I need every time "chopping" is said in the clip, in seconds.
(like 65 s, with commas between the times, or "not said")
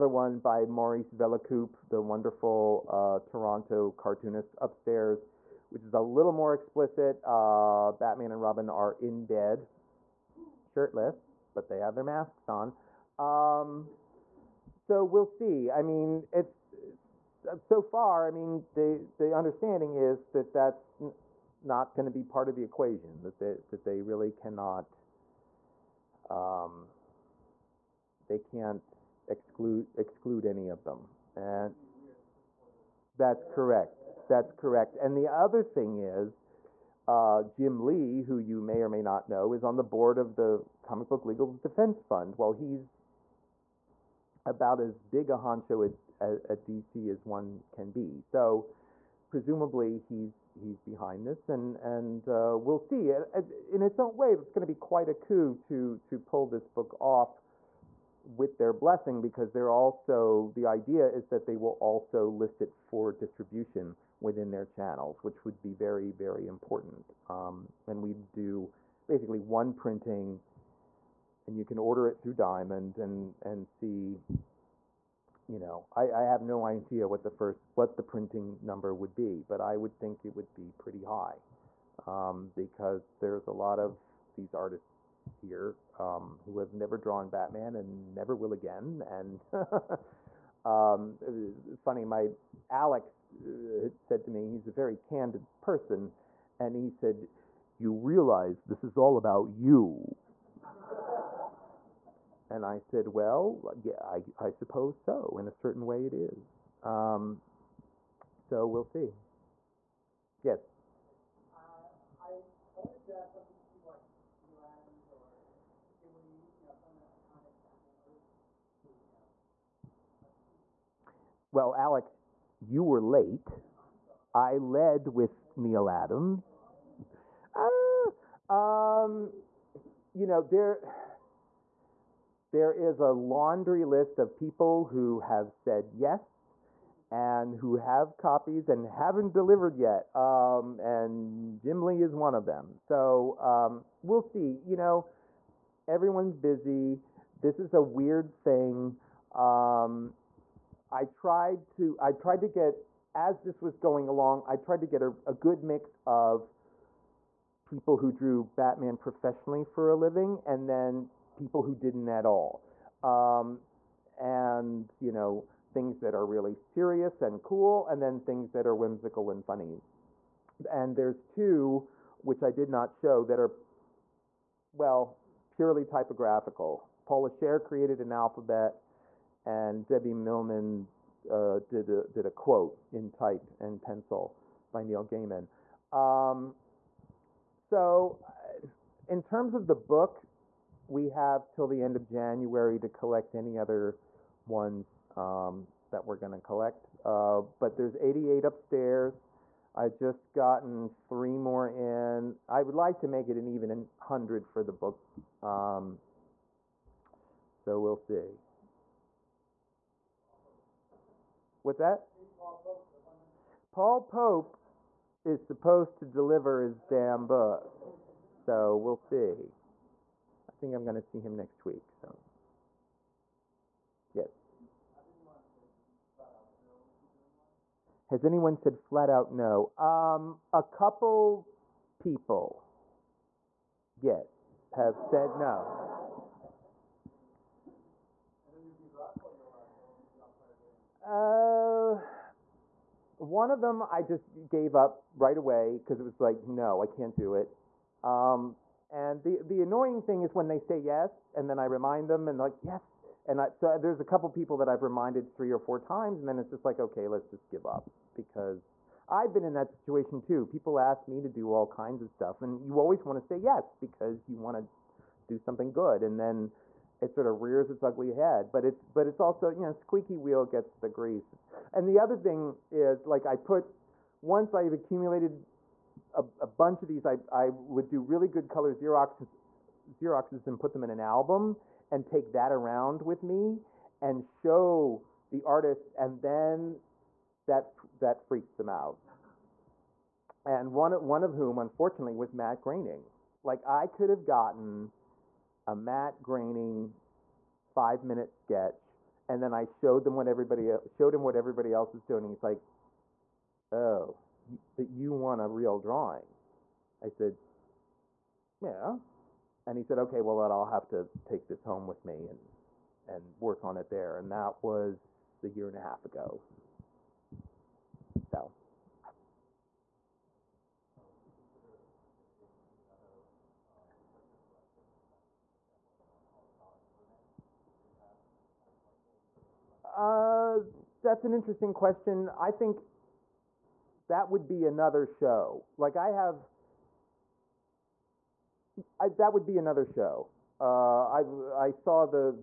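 not said.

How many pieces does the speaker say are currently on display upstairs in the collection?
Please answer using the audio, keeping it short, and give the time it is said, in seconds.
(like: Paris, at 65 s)
88, at 197 s.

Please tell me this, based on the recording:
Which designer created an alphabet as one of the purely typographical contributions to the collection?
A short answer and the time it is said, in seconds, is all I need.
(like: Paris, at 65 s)
Paula Scher, at 177 s.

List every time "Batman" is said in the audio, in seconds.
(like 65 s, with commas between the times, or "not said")
7 s, 87 s, 158 s.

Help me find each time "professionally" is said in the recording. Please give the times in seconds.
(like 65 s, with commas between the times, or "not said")
158 s.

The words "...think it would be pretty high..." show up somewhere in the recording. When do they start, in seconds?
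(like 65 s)
79 s.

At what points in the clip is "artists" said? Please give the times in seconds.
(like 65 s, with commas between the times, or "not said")
84 s, 285 s.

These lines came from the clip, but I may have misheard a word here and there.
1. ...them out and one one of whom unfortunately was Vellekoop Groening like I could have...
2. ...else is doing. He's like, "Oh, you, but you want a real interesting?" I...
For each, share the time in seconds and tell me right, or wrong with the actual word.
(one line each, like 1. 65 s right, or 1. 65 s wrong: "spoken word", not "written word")
1. 288 s wrong: "Matt", not "Vellekoop"
2. 301 s wrong: "drawing", not "interesting".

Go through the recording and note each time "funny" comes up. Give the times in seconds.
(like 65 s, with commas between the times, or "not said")
91 s, 169 s.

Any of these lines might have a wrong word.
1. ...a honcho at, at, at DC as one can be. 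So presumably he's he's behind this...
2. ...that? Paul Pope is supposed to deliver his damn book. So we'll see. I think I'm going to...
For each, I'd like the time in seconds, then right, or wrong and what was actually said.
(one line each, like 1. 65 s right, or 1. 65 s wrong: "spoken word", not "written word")
1. 45 s right
2. 211 s right.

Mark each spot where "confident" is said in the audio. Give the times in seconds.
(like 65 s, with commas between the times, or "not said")
not said.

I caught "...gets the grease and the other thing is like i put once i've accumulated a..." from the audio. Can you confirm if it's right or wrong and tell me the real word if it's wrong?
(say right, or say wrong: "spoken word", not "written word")
right.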